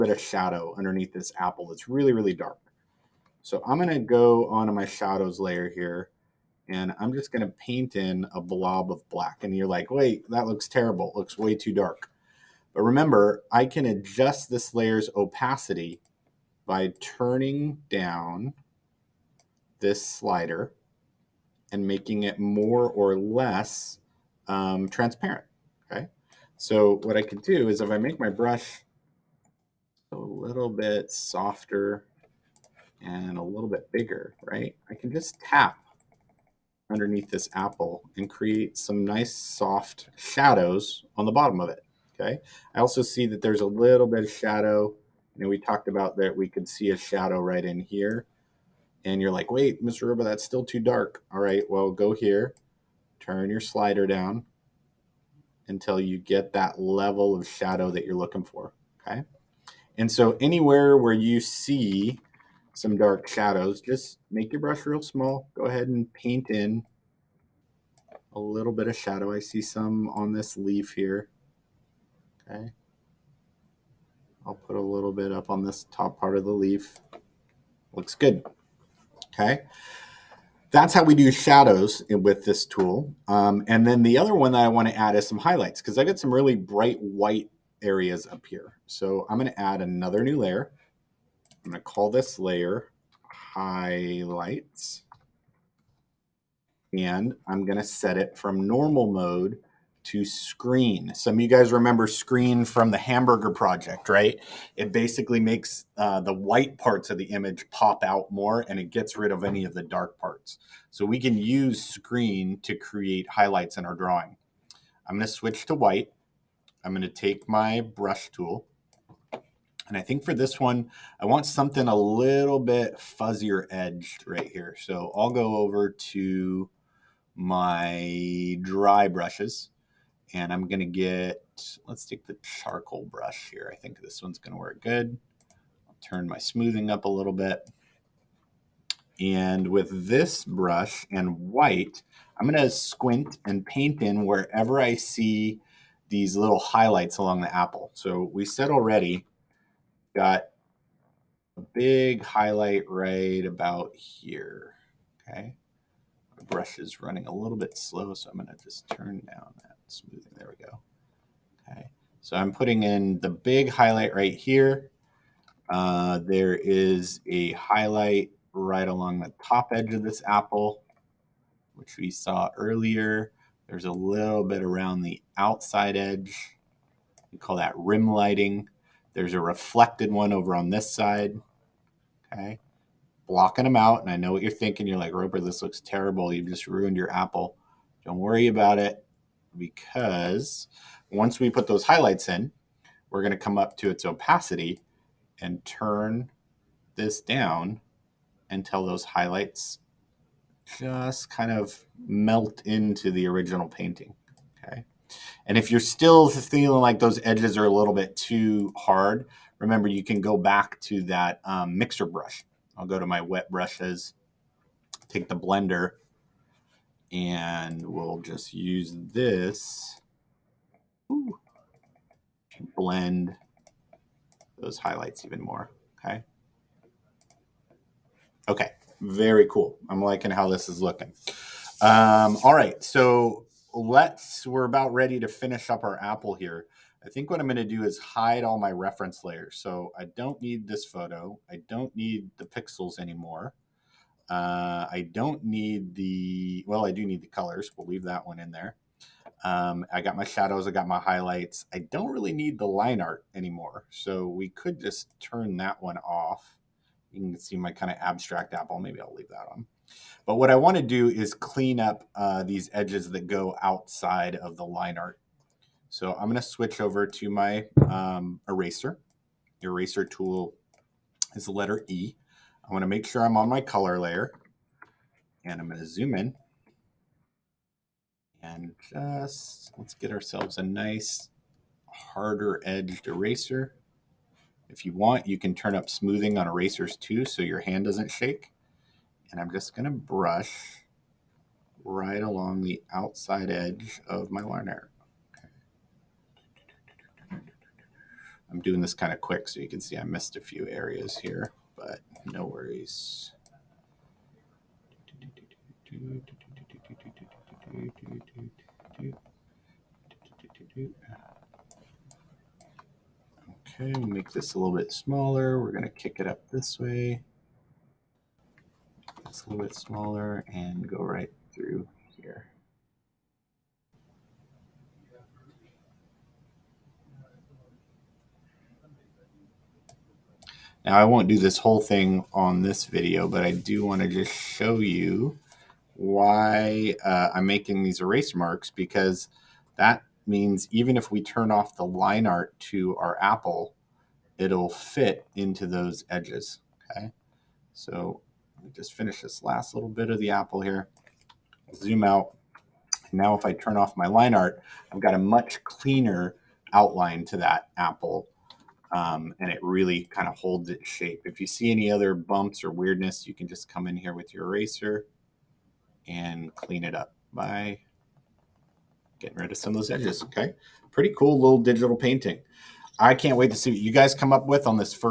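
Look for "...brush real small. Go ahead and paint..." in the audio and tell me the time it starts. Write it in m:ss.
1:04.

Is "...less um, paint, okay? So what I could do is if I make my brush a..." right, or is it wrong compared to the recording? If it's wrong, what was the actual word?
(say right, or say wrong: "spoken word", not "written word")
wrong: "transparent", not "paint".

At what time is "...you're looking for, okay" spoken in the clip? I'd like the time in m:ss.
0:58.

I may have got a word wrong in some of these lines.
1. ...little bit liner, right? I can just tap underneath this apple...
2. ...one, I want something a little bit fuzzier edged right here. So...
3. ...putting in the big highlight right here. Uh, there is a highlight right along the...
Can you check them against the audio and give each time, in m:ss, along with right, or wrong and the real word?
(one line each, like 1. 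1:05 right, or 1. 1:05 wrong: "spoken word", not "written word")
1. 0:33 wrong: "bigger", not "liner"
2. 2:00 right
3. 2:42 right.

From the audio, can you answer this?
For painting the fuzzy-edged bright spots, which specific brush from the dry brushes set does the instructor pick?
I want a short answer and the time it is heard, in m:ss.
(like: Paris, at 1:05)
charcoal brush, at 2:12.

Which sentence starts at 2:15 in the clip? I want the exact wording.
I'll turn my smoothing up a little bit.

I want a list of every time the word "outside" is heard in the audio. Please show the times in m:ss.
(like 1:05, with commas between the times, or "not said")
2:55, 4:23, 4:52.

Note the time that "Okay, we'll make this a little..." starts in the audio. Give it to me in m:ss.
5:13.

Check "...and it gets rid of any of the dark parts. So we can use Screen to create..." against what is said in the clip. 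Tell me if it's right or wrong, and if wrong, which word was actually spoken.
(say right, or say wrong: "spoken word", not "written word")
right.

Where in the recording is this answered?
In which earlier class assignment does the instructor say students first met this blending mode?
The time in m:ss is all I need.
1:42.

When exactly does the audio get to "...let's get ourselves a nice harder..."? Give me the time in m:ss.
4:39.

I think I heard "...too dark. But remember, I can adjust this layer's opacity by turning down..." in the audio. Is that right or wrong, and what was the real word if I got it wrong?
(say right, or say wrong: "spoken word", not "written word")
right.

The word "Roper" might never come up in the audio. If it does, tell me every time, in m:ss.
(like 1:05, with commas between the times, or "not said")
0:50, 3:05.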